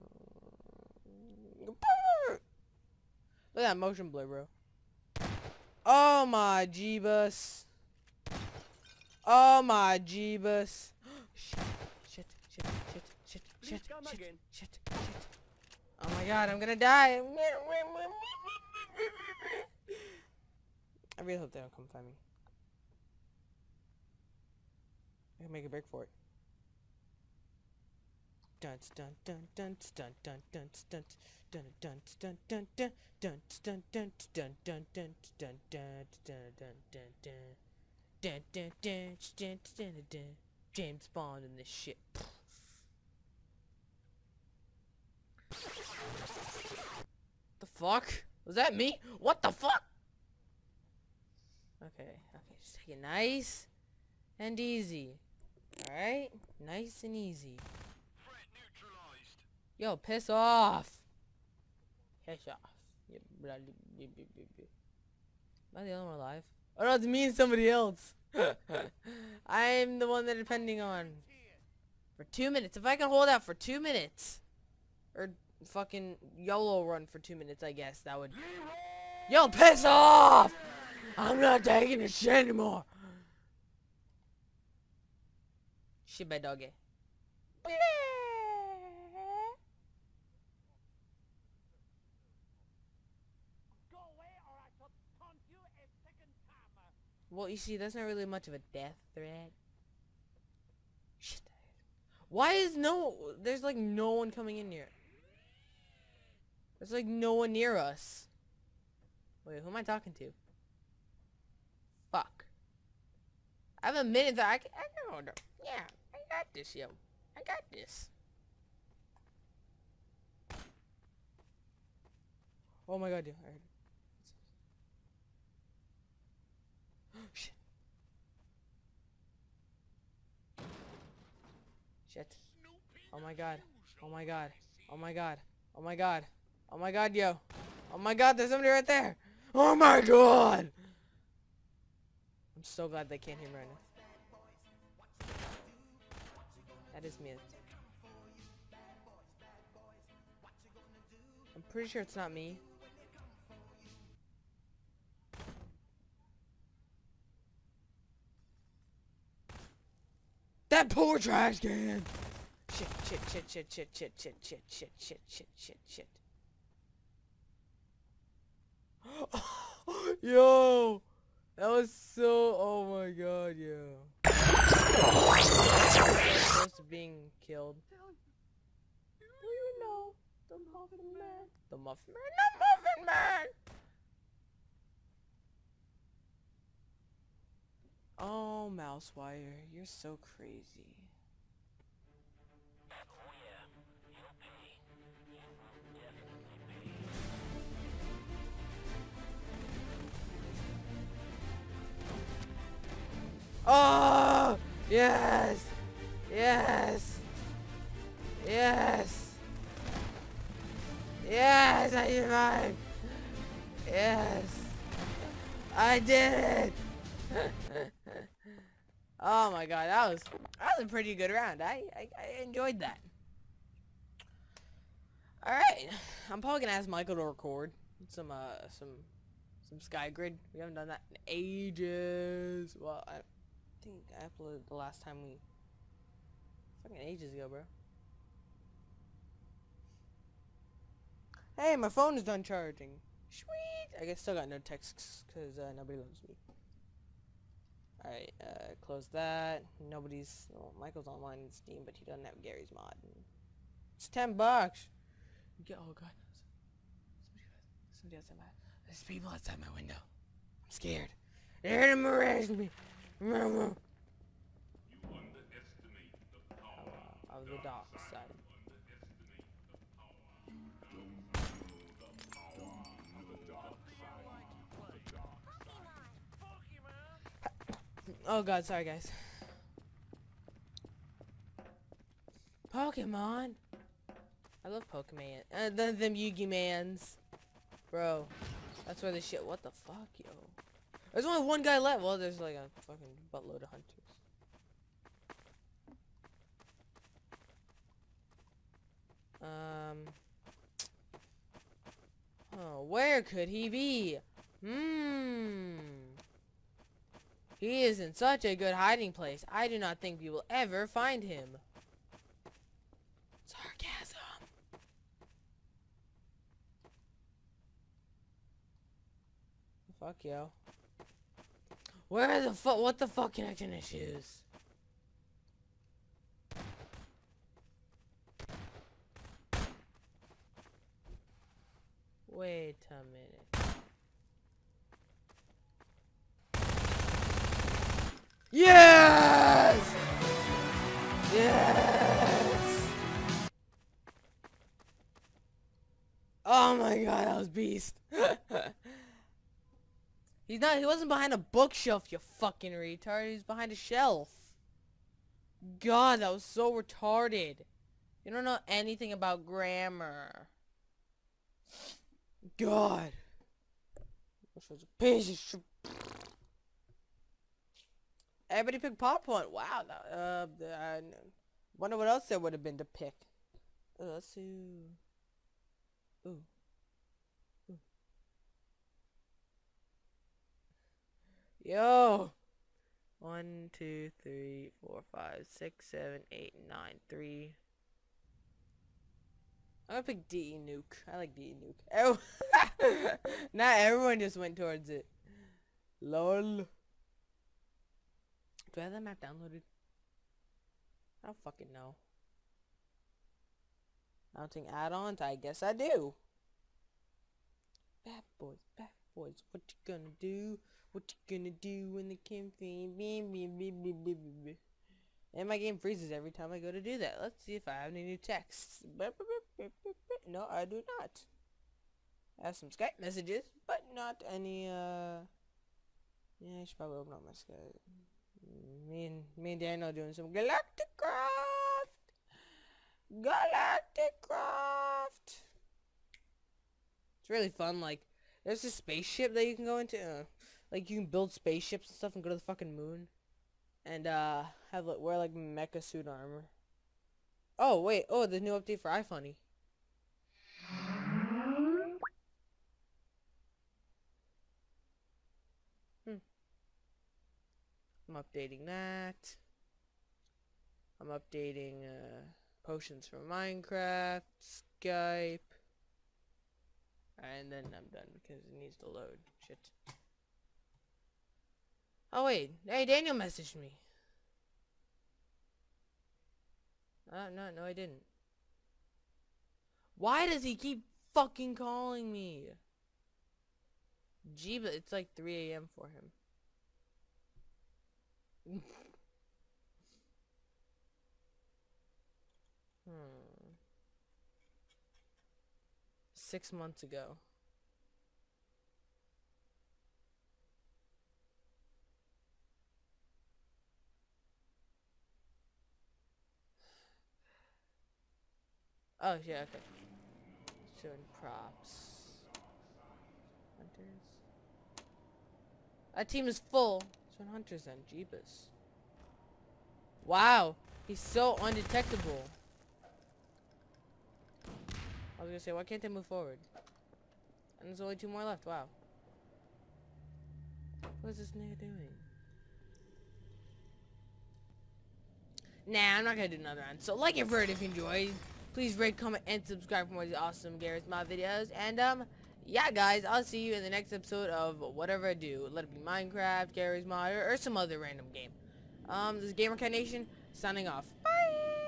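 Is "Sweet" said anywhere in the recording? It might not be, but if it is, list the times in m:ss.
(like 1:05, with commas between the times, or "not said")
4:03.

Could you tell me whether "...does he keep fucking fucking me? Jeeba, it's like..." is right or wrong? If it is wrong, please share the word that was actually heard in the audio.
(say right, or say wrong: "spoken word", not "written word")
wrong: "calling", not "fucking".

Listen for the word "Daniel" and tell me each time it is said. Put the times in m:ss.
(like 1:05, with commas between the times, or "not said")
7:09, 7:52.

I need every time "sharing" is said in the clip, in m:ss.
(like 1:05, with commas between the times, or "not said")
not said.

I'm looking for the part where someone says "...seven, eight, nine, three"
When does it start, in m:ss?
6:25.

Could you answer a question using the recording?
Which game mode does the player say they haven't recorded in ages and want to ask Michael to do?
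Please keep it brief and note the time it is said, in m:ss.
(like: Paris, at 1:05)
Skygrid, at 3:49.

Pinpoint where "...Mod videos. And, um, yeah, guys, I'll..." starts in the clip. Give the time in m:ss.
9:00.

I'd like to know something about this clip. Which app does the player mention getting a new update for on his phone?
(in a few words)
iFunny.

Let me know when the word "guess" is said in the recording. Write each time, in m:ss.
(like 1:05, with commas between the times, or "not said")
1:17, 4:04, 6:45.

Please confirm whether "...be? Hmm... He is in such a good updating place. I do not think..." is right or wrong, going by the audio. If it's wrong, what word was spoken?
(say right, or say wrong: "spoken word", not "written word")
wrong: "hiding", not "updating".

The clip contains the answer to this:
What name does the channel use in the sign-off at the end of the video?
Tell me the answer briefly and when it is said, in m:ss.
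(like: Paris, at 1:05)
Gamer Nation, at 9:09.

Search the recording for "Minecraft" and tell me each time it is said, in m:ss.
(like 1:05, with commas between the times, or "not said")
7:43, 9:05.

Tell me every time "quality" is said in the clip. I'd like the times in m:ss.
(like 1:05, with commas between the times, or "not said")
not said.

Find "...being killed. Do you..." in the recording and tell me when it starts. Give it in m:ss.
2:56.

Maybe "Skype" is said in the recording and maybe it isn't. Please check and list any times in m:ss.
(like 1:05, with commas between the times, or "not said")
7:02, 7:07, 7:44.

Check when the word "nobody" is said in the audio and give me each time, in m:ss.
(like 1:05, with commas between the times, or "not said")
4:05, 4:09.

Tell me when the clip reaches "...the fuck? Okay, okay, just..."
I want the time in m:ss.
0:49.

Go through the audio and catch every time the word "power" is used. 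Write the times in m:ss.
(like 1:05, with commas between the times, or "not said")
4:26.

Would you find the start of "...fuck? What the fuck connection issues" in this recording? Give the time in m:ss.
5:22.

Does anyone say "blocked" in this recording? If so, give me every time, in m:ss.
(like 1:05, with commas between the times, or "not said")
not said.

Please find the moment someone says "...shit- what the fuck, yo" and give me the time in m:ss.
4:49.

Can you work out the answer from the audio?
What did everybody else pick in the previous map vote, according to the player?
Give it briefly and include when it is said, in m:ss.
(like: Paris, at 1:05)
popcorn, at 6:08.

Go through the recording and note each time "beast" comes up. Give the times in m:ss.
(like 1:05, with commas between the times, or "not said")
5:47.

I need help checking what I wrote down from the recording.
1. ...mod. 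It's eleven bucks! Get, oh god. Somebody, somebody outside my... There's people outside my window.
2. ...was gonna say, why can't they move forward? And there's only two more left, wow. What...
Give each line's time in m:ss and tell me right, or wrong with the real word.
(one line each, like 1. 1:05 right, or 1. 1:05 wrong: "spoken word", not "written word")
1. 4:12 wrong: "ten", not "eleven"
2. 8:45 right.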